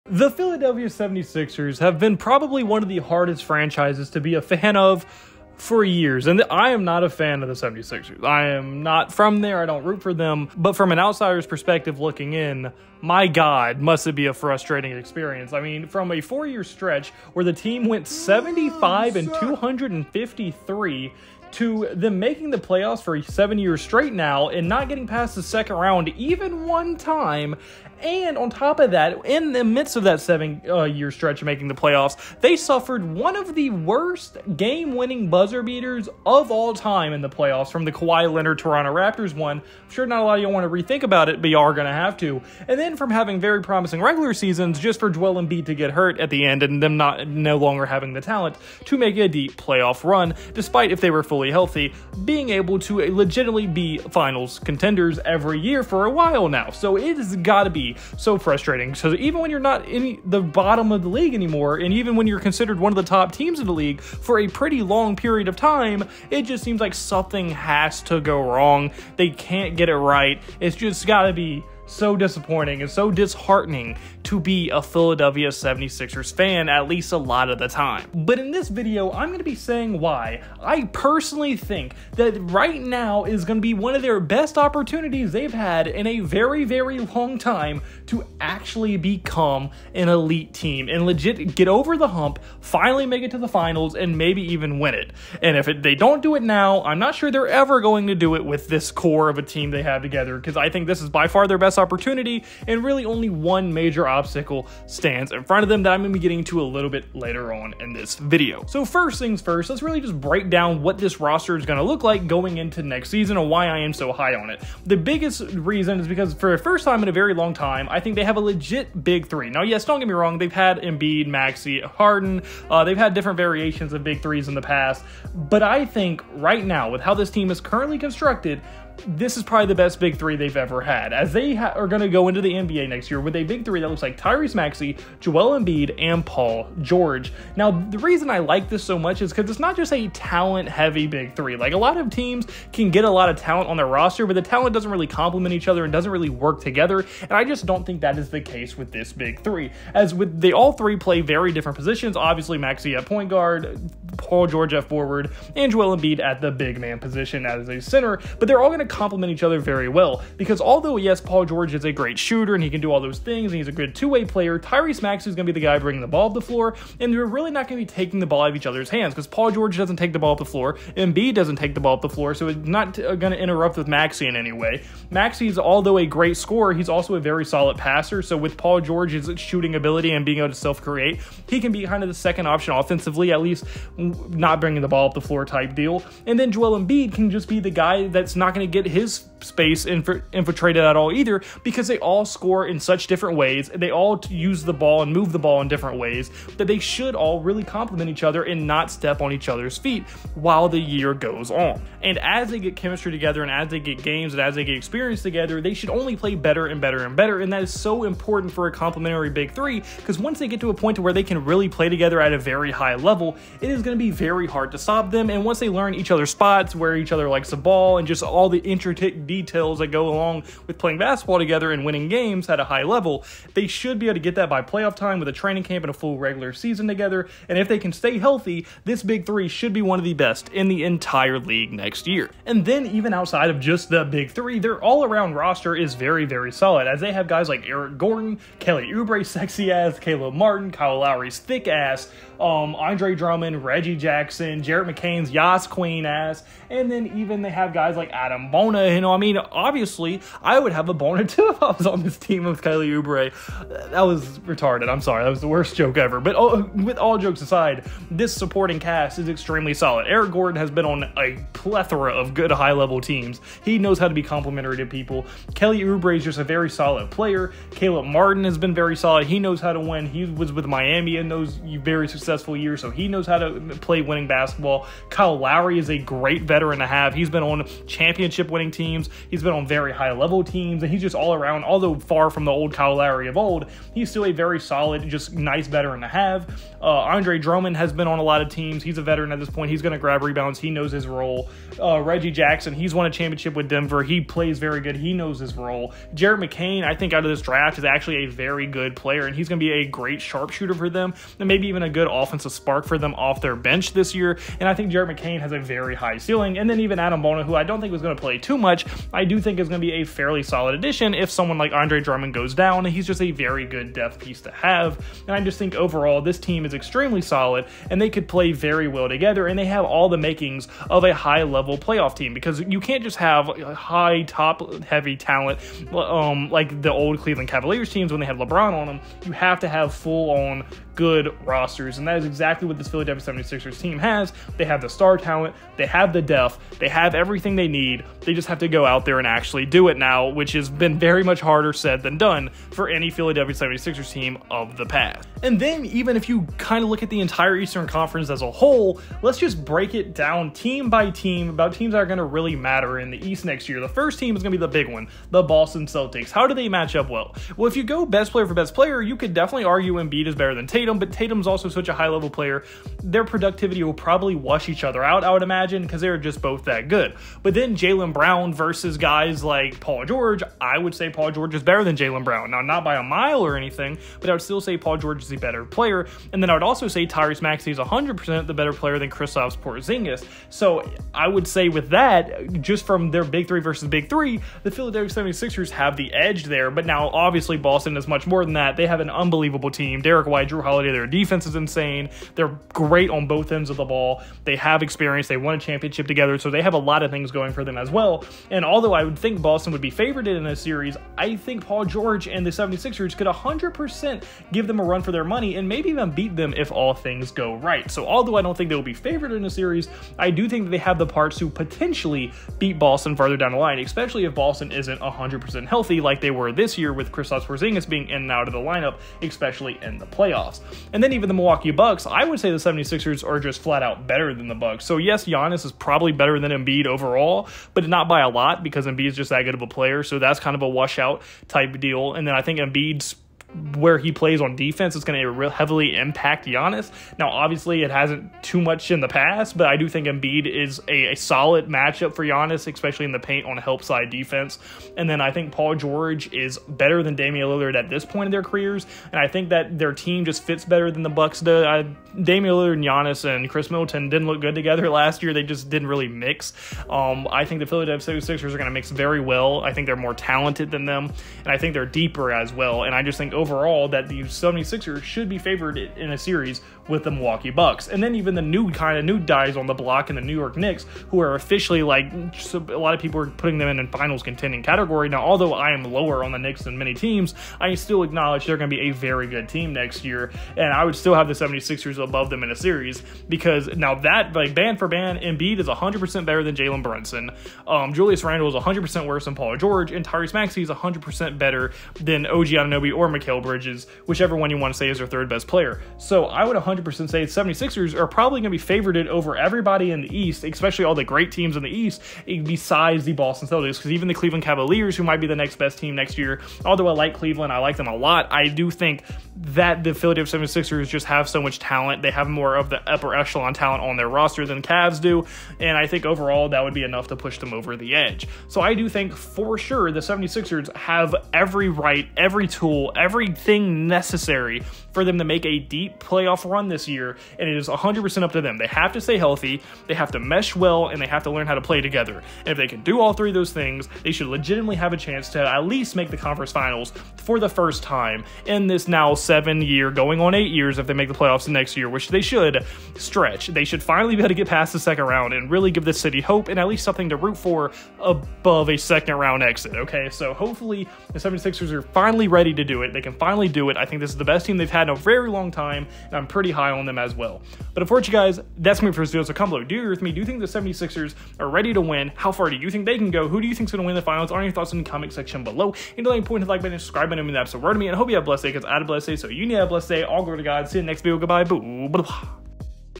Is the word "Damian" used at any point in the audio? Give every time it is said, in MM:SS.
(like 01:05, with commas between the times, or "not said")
07:27, 07:32.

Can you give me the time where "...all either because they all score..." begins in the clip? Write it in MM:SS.
03:10.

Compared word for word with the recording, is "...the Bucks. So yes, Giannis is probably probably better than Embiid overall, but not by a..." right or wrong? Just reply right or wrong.
right.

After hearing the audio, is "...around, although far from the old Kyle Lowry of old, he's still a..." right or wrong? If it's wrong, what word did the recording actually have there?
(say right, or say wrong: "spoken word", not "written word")
right.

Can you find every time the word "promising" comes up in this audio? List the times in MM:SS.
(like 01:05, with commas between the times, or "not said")
00:43.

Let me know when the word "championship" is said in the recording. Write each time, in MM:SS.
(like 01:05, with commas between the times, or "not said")
04:37, 04:53, 06:35.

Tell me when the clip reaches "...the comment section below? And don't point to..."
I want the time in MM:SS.
09:24.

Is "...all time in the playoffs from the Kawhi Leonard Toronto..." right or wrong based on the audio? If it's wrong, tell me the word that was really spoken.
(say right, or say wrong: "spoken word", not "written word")
right.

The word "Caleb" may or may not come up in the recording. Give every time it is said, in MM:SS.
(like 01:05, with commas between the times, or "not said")
03:59, 04:27.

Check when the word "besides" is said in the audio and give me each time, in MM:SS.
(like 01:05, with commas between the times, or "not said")
08:22.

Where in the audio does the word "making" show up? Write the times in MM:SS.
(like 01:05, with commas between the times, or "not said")
00:22, 00:31, 05:20.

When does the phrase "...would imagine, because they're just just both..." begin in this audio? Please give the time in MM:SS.
06:05.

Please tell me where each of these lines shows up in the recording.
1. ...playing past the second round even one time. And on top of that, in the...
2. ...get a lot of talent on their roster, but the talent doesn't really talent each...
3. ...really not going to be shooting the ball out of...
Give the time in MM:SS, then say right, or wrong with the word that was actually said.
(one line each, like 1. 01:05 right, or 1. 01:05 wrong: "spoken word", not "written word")
1. 00:24 wrong: "getting", not "playing"
2. 02:22 wrong: "complement", not "talent"
3. 02:47 wrong: "taking", not "shooting".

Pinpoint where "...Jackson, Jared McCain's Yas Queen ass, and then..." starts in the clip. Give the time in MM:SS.
04:03.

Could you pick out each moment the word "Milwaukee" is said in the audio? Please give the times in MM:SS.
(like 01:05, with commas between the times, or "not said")
07:01, 07:47.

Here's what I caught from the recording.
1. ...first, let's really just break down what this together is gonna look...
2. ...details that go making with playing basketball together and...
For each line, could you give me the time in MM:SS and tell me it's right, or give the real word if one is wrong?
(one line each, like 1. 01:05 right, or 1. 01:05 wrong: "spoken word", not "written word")
1. 01:49 wrong: "roster", not "together"
2. 03:39 wrong: "along", not "making".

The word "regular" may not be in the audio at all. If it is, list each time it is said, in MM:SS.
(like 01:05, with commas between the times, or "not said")
00:44, 03:46.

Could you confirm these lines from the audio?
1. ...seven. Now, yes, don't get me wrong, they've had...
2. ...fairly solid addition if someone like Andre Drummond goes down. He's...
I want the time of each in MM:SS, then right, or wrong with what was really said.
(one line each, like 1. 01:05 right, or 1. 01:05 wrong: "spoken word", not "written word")
1. 01:59 wrong: "three", not "seven"
2. 05:10 right.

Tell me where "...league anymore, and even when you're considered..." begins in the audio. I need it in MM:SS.
01:01.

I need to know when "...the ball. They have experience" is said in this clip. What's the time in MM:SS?
06:33.